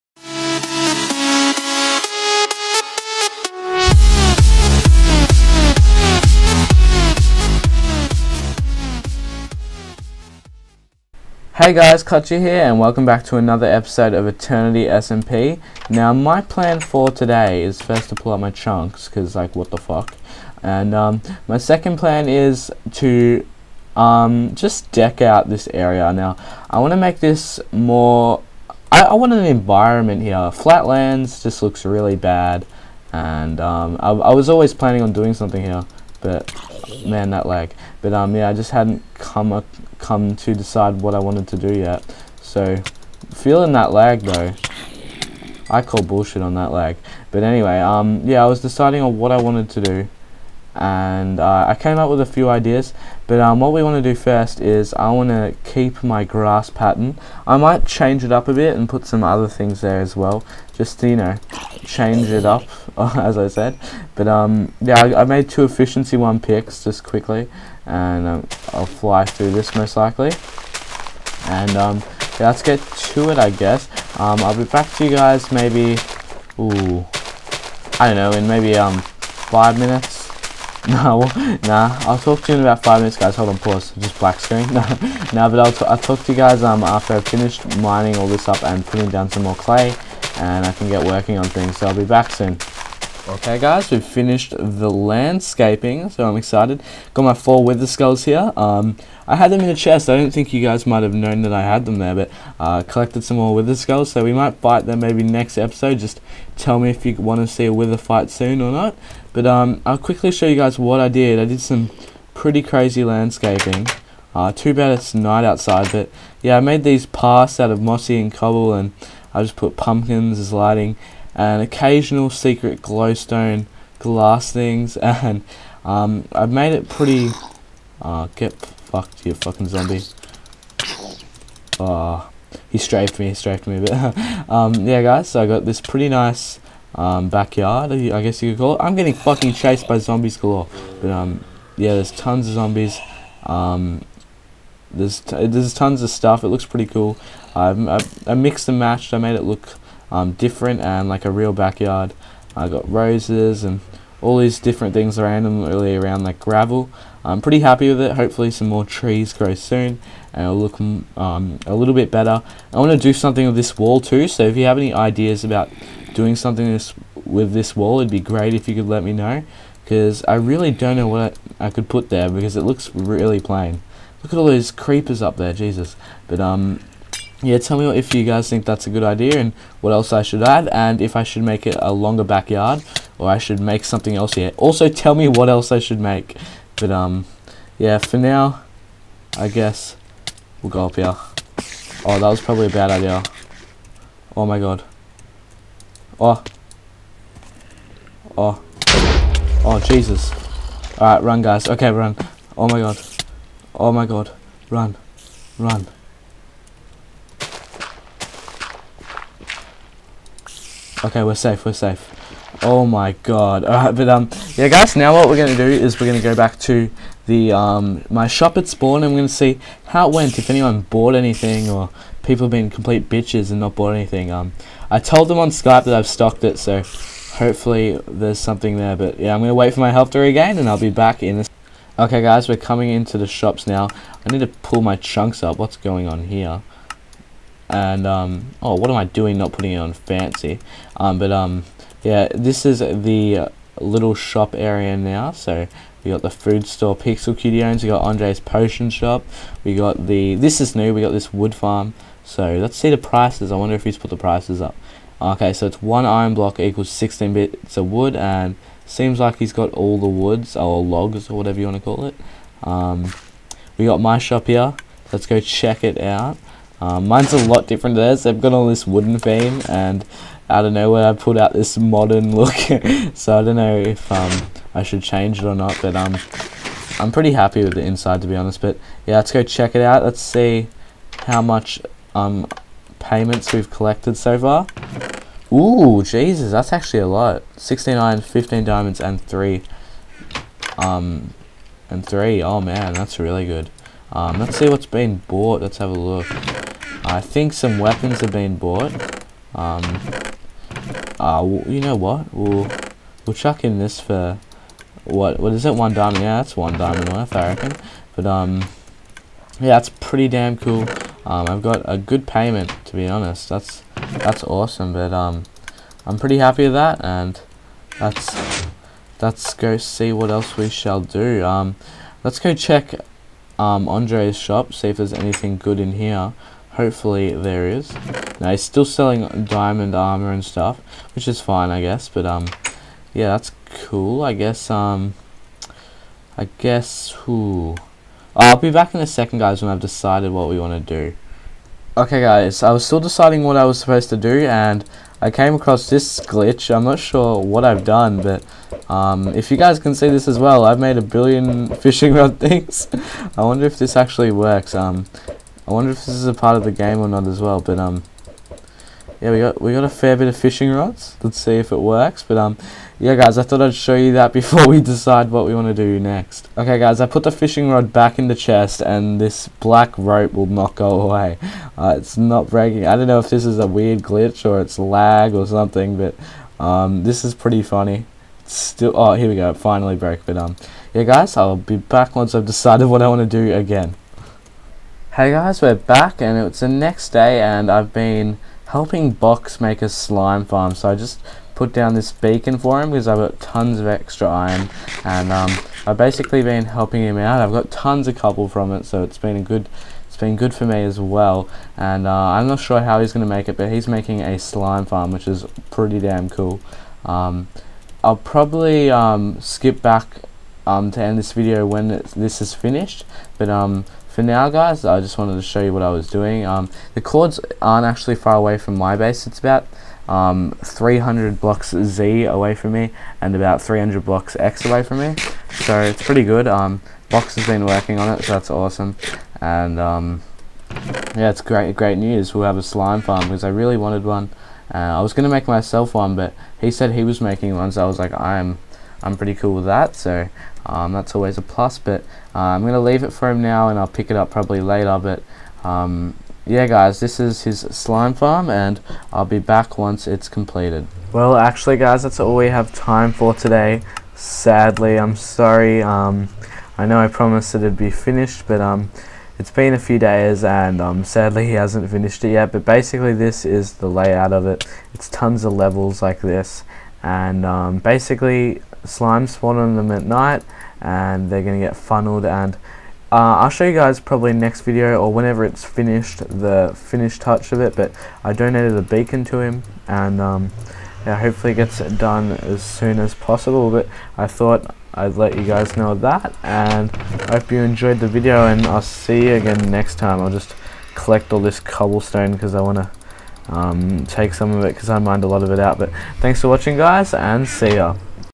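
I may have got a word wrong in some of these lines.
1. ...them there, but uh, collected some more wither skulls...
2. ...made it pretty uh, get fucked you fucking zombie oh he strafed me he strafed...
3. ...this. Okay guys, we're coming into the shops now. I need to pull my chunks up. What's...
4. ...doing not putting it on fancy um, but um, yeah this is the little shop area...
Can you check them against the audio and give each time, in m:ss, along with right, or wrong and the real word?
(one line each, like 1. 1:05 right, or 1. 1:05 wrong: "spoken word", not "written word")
1. 1:41 right
2. 2:06 right
3. 3:51 right
4. 3:59 right.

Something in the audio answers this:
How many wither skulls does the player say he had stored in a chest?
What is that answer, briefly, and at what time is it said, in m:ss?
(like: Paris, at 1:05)
4, at 1:37.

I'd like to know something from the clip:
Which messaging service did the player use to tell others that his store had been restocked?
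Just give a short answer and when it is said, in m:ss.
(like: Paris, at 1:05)
Skype, at 3:45.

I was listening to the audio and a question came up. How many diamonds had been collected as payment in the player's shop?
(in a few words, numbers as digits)
15.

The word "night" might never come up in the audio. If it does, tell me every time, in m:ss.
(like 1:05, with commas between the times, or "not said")
1:55, 7:50.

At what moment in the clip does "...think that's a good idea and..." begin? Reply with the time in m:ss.
2:58.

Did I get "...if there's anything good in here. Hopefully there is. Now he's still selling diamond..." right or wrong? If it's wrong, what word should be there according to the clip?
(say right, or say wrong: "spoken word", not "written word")
right.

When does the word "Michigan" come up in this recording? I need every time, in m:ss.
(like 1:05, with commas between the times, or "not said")
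not said.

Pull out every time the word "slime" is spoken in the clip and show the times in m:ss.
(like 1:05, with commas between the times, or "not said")
6:29, 6:44, 7:12, 7:27, 7:48.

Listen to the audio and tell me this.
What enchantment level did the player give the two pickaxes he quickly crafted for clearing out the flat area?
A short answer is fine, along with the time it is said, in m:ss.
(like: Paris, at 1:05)
Efficiency 1, at 1:05.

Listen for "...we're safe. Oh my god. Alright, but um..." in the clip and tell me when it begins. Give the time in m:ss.
3:31.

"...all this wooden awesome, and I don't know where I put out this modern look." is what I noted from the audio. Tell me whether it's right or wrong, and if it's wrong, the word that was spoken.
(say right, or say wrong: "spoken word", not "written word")
wrong: "theme", not "awesome".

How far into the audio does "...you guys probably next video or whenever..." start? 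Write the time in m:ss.
7:53.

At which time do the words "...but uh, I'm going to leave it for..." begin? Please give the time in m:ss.
7:21.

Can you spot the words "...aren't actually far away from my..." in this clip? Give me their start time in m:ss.
6:57.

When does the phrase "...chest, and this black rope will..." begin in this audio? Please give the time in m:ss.
6:08.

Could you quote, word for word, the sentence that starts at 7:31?
Well, actually guys, that's all we have time for today.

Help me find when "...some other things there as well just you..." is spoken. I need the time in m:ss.
0:59.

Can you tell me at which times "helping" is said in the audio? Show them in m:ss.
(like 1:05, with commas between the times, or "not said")
6:28, 6:36.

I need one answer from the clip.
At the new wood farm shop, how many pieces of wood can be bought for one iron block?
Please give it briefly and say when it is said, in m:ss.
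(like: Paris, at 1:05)
16, at 4:16.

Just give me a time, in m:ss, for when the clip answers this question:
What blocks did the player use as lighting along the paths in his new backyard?
1:59.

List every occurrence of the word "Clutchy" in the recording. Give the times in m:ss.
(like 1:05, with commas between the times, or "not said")
0:12.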